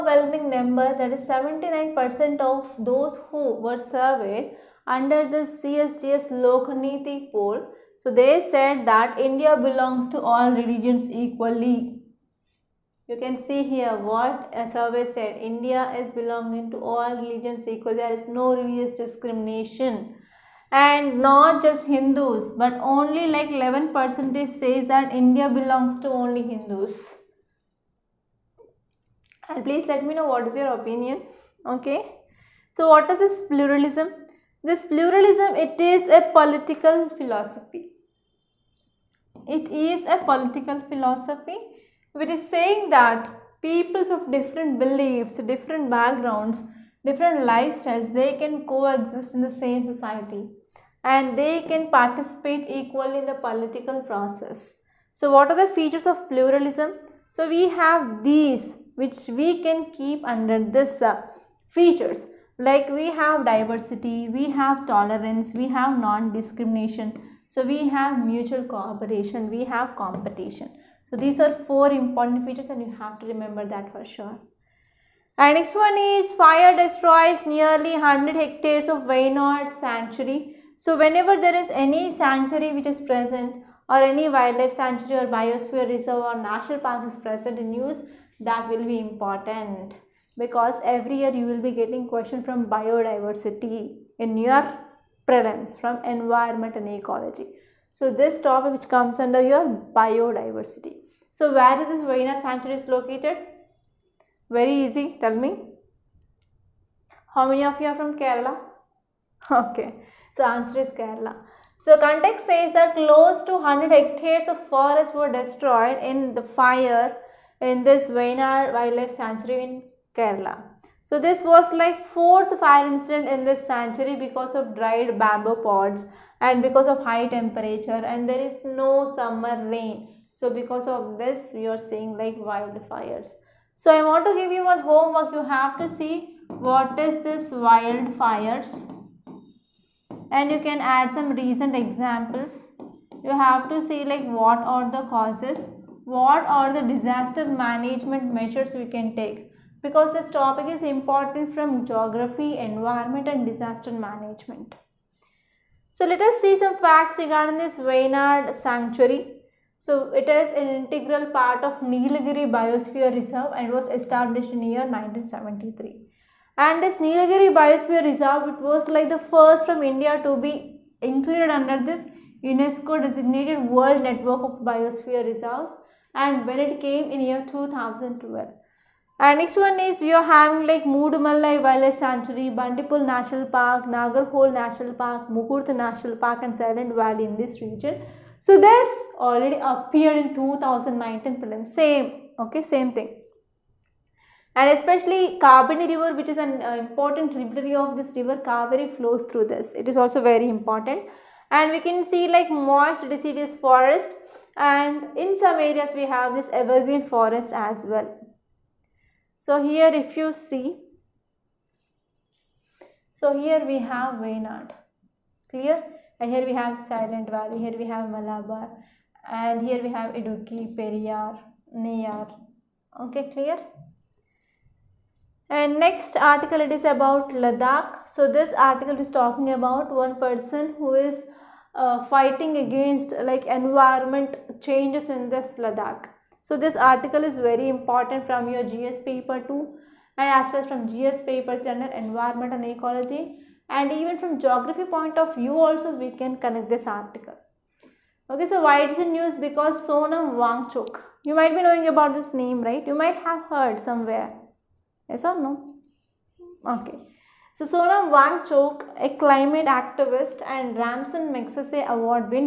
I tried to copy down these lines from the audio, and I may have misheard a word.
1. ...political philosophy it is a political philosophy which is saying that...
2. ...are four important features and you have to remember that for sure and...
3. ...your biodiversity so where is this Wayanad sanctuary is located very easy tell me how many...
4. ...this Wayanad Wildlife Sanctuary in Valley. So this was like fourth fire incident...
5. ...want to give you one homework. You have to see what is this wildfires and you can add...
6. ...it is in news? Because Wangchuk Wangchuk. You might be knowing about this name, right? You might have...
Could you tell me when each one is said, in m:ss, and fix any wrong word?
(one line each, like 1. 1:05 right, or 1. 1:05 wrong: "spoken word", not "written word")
1. 0:36 right
2. 1:11 right
3. 1:39 right
4. 1:57 wrong: "Kerala", not "Valley"
5. 2:14 right
6. 4:08 wrong: "Sonam", not "Wangchuk".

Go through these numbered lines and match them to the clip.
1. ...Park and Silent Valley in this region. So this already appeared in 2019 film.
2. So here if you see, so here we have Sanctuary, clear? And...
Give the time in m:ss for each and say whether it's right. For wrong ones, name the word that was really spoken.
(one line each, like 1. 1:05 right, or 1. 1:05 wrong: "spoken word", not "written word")
1. 3:06 right
2. 3:29 wrong: "Wayanad", not "Sanctuary".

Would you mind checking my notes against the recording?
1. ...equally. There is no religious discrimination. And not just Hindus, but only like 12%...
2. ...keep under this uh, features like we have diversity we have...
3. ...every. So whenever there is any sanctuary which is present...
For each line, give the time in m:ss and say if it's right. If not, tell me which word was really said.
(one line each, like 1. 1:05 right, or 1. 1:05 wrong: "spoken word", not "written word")
1. 0:17 wrong: "11", not "12"
2. 0:59 right
3. 1:19 wrong: "sanctuary", not "every".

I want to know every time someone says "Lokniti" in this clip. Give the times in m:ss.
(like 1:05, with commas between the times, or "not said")
0:06.